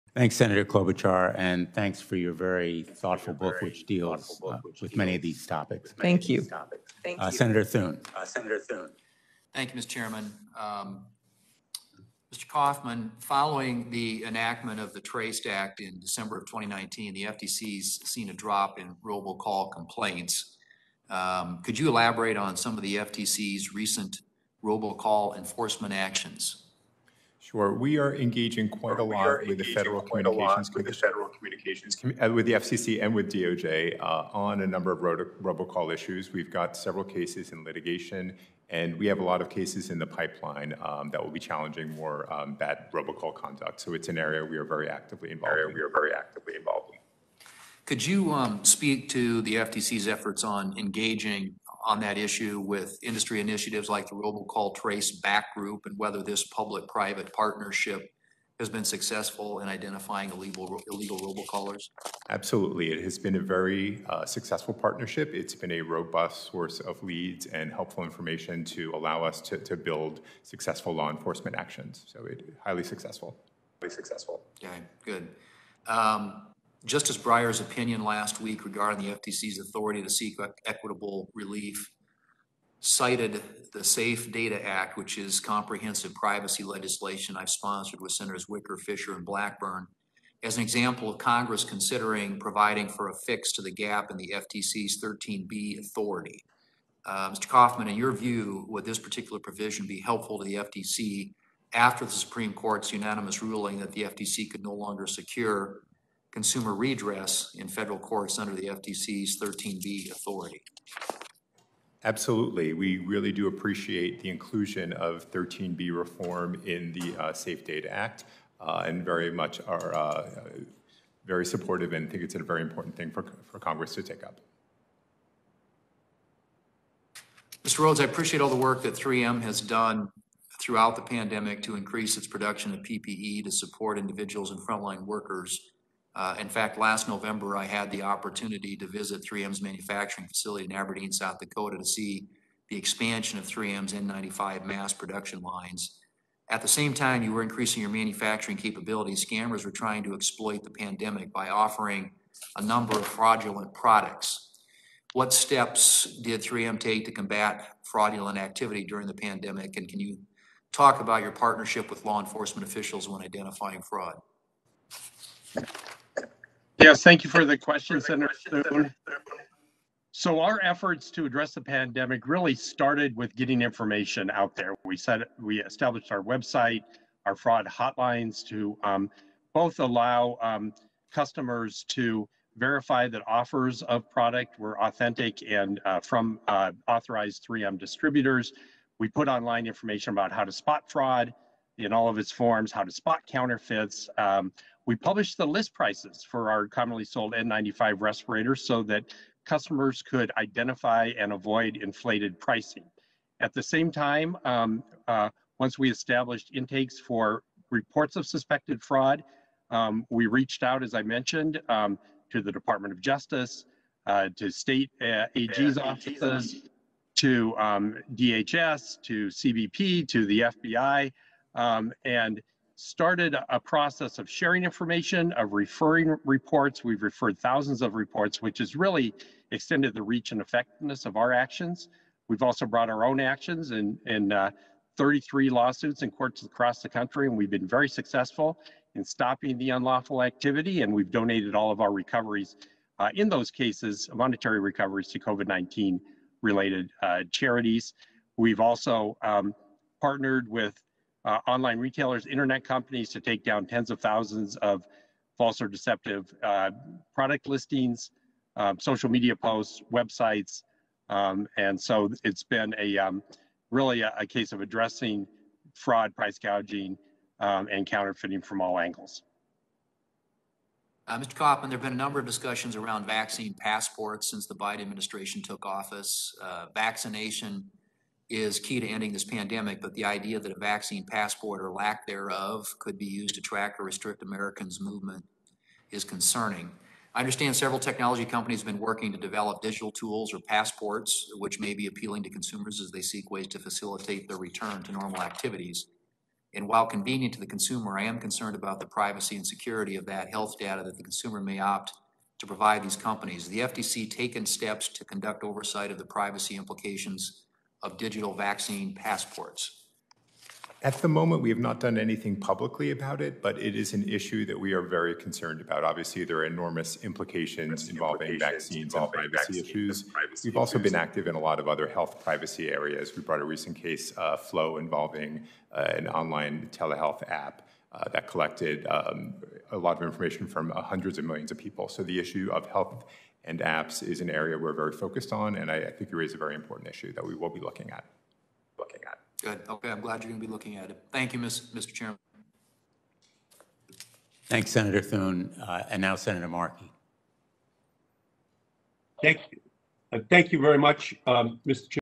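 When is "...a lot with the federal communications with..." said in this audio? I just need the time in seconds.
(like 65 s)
28 s.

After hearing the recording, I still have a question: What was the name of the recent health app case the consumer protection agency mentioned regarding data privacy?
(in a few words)
Flo.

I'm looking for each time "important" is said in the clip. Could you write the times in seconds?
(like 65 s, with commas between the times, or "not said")
122 s, 336 s.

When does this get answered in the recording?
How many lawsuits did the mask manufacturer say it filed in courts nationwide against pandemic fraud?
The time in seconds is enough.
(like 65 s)
234 s.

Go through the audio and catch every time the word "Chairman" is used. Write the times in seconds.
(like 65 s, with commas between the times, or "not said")
9 s, 341 s, 351 s.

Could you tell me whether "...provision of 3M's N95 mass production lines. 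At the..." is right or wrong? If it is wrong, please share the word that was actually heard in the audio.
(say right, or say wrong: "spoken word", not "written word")
wrong: "expansion", not "provision".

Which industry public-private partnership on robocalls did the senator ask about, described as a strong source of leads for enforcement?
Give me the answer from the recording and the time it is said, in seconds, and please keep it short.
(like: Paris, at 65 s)
Robocall Trace Back Group, at 54 s.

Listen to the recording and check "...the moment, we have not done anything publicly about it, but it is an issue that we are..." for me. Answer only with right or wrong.
right.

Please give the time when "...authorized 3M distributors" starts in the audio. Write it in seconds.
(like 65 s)
186 s.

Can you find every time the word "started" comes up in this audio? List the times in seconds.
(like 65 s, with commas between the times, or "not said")
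172 s, 222 s.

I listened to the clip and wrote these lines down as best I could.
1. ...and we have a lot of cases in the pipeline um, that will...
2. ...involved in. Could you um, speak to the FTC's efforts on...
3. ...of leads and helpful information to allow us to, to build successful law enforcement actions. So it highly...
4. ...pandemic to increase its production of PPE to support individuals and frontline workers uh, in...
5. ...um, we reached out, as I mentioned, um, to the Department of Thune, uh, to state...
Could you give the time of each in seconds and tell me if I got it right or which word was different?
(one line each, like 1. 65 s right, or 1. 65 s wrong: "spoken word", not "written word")
1. 38 s right
2. 46 s right
3. 66 s right
4. 131 s right
5. 209 s wrong: "Justice", not "Thune".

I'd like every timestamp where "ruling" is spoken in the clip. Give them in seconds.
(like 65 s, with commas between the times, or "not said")
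103 s.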